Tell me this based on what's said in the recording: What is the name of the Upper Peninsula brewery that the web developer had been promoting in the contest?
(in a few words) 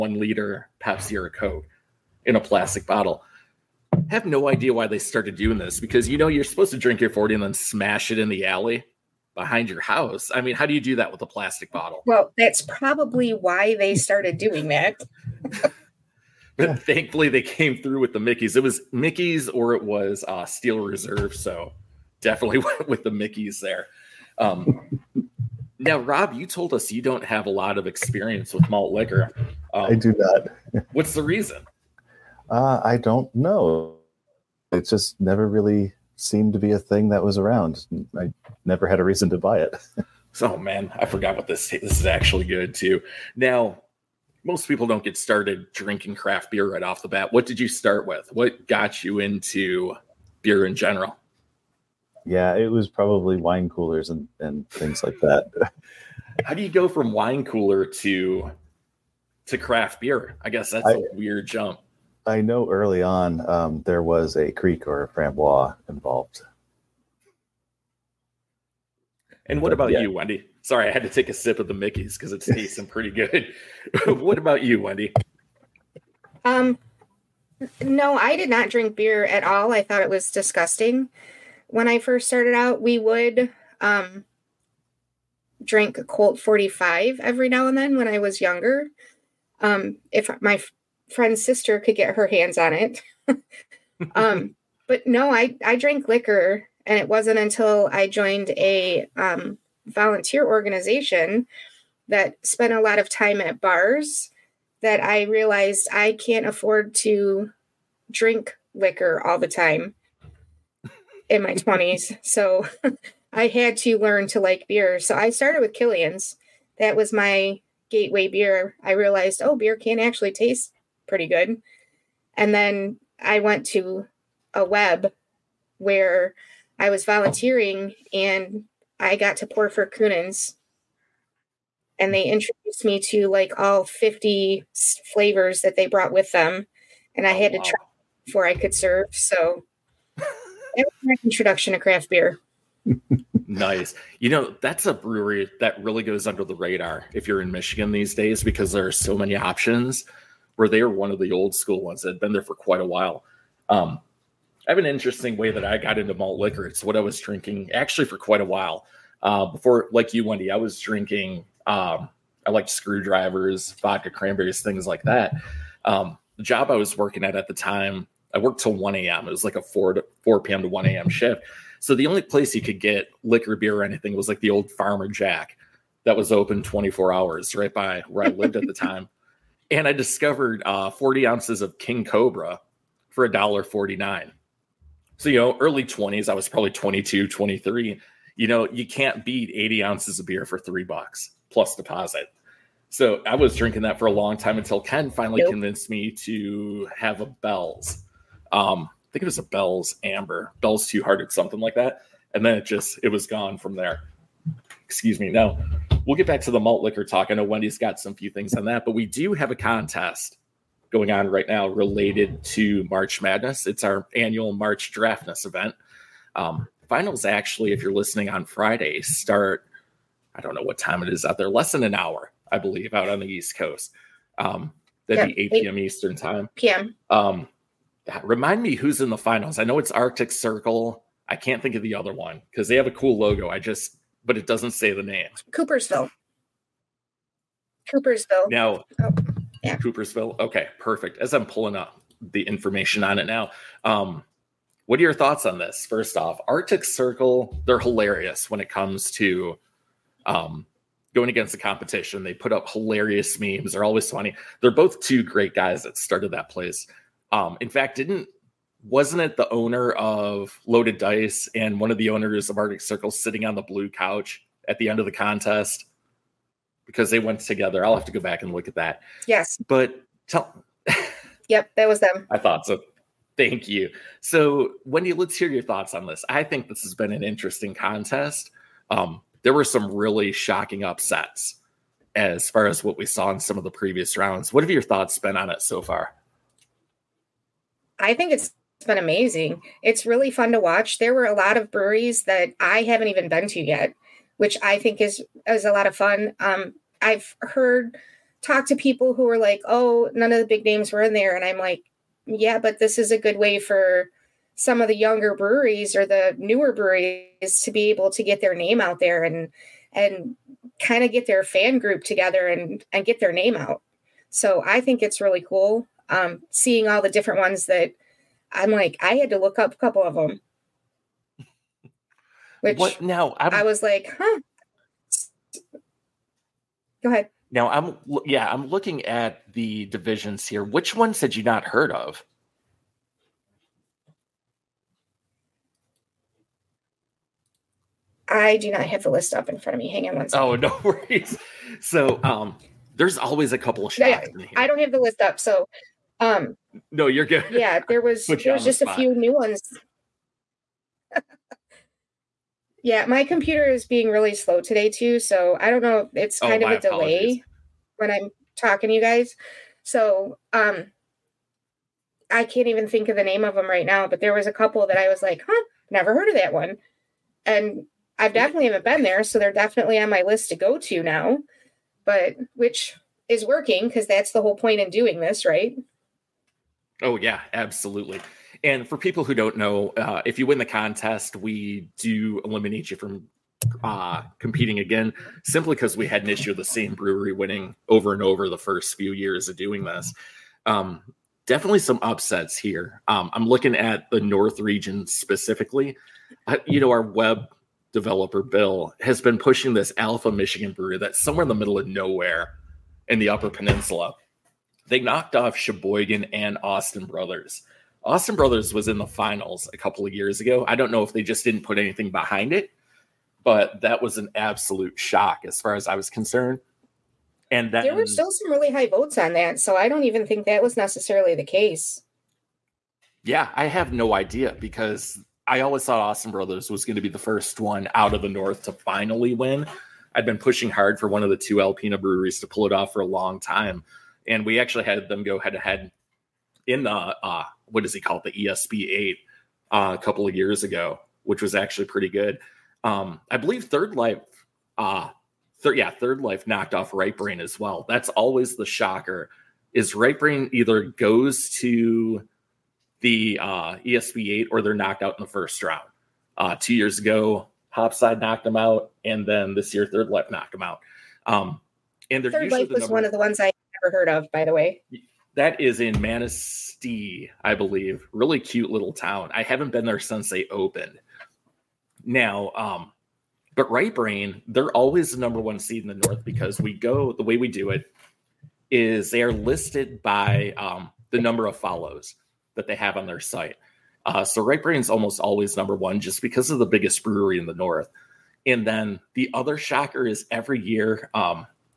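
Alpha Michigan.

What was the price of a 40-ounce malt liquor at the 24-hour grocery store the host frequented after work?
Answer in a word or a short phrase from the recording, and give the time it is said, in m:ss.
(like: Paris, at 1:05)
$1.49, at 3:03.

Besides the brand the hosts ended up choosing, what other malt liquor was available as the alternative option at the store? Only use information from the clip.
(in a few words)
Steel Reserve.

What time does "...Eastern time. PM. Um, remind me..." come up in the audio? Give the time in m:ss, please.
3:45.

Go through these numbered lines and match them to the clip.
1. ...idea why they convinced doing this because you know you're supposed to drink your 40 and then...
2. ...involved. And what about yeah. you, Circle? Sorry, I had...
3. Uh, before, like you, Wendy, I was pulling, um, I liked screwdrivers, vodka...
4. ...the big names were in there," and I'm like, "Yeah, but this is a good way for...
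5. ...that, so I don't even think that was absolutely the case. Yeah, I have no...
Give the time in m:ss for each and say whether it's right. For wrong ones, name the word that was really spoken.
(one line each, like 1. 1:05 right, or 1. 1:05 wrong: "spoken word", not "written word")
1. 0:04 wrong: "started", not "convinced"
2. 1:05 wrong: "Wendy", not "Circle"
3. 2:39 wrong: "drinking", not "pulling"
4. 5:00 right
5. 6:59 wrong: "necessarily", not "absolutely".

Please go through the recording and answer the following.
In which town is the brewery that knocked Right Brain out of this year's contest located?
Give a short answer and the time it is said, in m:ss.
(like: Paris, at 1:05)
Manistee, at 7:46.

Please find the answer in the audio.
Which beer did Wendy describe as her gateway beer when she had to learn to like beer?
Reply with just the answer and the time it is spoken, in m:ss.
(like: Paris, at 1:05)
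Killian's, at 1:55.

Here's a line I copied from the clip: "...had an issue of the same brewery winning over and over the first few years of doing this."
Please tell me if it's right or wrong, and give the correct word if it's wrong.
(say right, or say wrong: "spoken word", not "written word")
right.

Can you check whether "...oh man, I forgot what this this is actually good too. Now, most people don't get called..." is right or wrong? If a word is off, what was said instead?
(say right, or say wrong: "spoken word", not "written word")
wrong: "started", not "called".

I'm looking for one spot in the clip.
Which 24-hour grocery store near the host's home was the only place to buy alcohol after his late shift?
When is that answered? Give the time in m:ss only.
2:54.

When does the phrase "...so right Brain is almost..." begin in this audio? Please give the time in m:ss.
8:04.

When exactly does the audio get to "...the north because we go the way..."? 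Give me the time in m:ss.
7:55.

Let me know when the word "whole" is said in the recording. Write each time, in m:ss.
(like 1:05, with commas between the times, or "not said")
6:14.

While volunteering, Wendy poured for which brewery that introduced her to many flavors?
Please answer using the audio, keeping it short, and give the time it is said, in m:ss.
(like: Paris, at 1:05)
Kuhnhenn's, at 2:09.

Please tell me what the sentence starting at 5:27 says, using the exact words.
Now I'm yeah, I'm looking at the divisions here.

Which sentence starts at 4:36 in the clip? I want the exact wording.
I think this has been an interesting contest.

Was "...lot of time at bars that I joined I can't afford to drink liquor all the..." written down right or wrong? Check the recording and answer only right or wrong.
wrong.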